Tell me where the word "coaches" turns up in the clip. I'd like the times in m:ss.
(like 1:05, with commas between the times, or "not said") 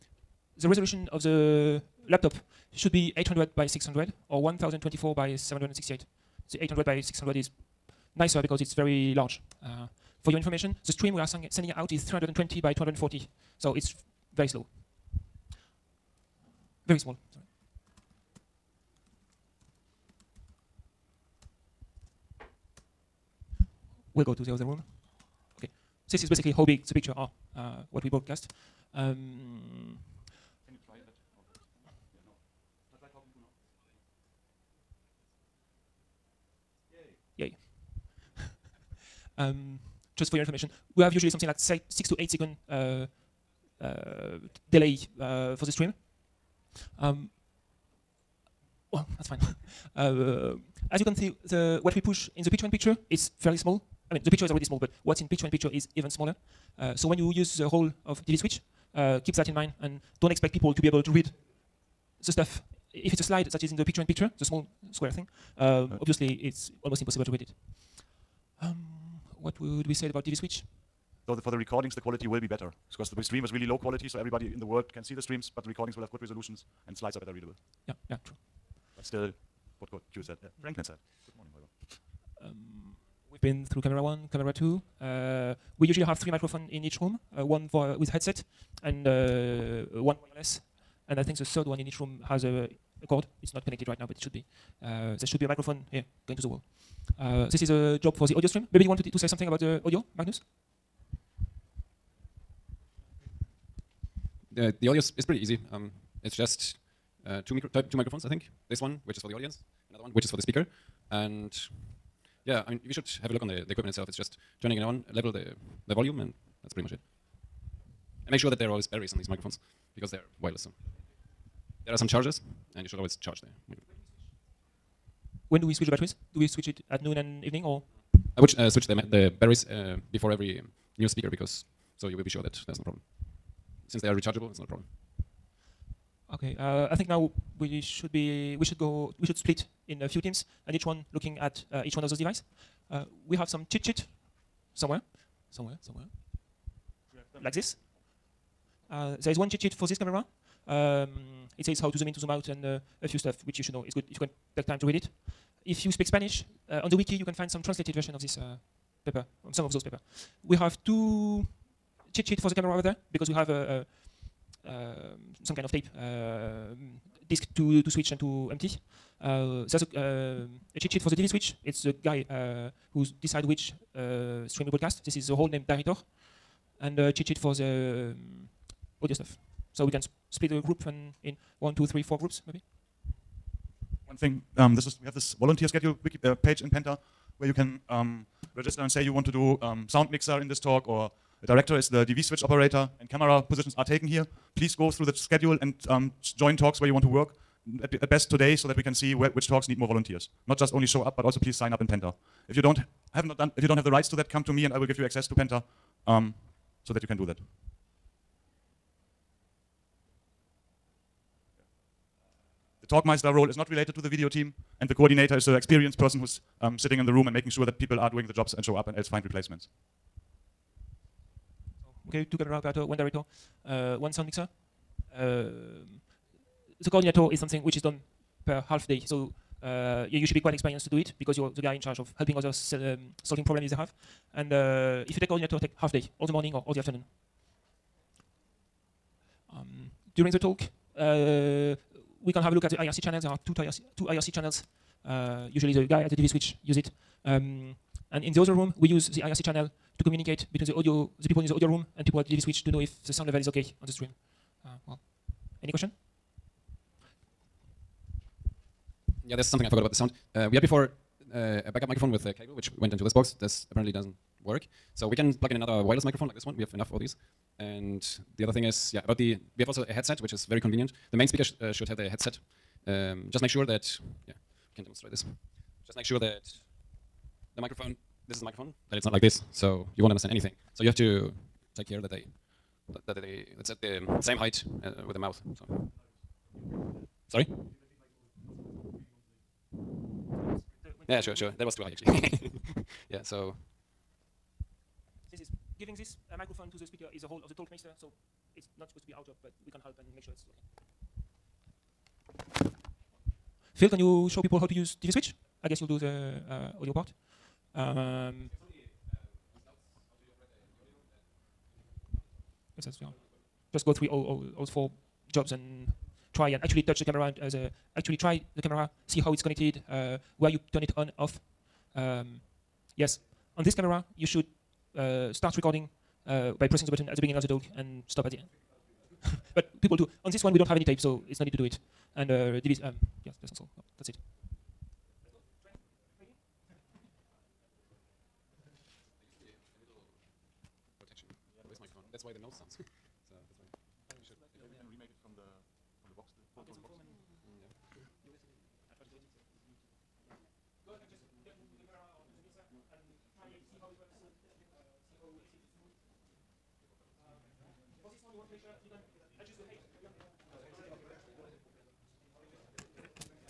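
not said.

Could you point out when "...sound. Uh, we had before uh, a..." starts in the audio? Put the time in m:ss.
4:19.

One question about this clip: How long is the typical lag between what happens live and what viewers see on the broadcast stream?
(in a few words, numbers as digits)
6 to 8 seconds.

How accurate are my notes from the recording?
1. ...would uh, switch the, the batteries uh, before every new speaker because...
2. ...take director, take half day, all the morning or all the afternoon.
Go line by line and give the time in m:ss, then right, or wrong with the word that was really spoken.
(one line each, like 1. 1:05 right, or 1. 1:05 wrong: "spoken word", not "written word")
1. 2:08 right
2. 3:55 wrong: "coordinator", not "director".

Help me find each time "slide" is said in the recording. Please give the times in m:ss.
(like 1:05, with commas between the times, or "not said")
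1:03, 1:16.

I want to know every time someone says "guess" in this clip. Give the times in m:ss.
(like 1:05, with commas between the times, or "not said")
5:05.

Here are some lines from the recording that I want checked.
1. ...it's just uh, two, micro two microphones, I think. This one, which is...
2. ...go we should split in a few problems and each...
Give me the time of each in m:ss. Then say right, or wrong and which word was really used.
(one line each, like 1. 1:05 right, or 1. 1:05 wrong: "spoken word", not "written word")
1. 1:46 right
2. 2:18 wrong: "teams", not "problems".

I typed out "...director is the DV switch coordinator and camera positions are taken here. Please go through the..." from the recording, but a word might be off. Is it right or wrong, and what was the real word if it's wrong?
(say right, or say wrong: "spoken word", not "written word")
wrong: "operator", not "coordinator".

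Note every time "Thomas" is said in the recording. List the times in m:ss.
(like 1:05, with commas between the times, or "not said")
not said.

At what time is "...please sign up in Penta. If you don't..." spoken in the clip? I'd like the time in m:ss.
3:21.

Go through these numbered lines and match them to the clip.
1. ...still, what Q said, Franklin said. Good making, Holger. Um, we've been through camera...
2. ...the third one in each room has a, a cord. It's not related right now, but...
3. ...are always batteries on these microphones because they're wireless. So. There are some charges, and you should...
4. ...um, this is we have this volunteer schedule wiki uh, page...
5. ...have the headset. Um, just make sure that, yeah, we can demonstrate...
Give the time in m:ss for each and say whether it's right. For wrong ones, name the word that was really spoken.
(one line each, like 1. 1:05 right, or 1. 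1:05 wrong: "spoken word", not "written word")
1. 1:19 wrong: "morning", not "making"
2. 1:31 wrong: "connected", not "related"
3. 1:58 right
4. 3:04 right
5. 4:31 right.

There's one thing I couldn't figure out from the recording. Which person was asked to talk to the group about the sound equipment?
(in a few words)
Magnus.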